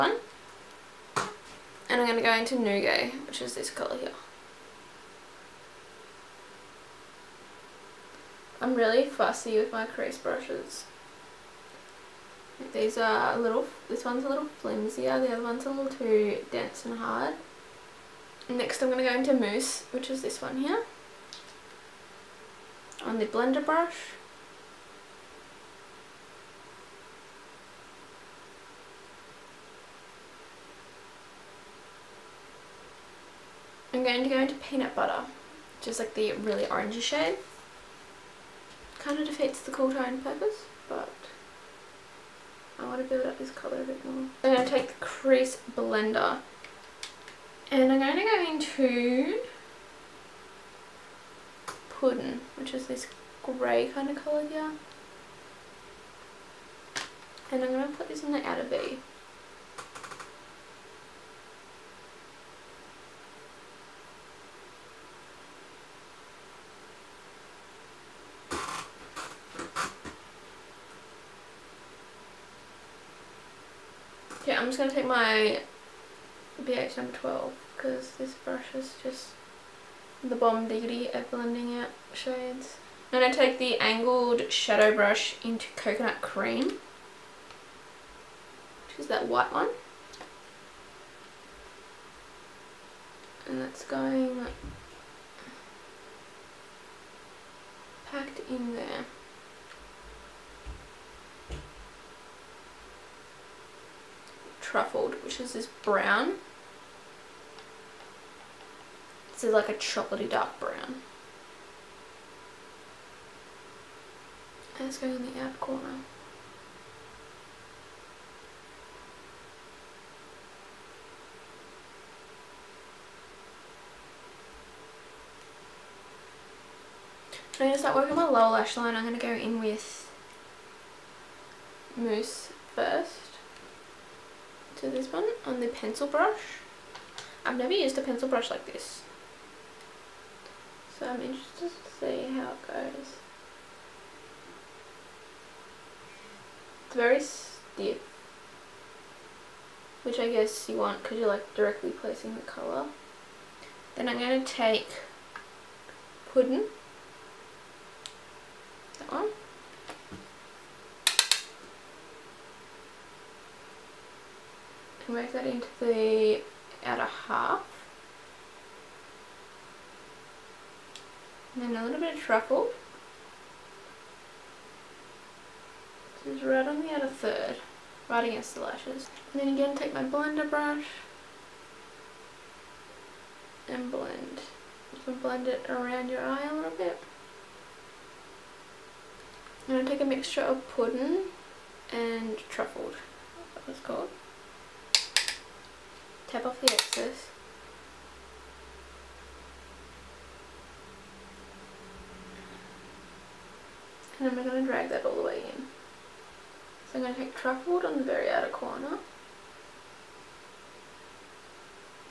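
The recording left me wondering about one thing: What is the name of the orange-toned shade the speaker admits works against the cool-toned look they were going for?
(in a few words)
Peanut butter.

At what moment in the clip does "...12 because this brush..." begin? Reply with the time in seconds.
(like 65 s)
77 s.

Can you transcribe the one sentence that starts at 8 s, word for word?
I'm really fussy with my crease brushes.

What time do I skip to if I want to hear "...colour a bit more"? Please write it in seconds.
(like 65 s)
43 s.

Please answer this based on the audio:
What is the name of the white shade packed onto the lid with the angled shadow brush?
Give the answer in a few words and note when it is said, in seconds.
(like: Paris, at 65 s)
Coconut cream, at 85 s.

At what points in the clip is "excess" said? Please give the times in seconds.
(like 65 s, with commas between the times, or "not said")
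196 s.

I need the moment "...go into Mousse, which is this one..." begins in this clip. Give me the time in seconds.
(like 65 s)
19 s.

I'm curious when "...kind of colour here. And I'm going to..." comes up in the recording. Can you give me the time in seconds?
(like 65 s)
53 s.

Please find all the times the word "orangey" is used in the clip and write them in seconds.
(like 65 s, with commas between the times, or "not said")
36 s.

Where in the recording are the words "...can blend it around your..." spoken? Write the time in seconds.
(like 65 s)
185 s.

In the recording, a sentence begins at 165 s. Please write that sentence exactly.
can work that into the outer half.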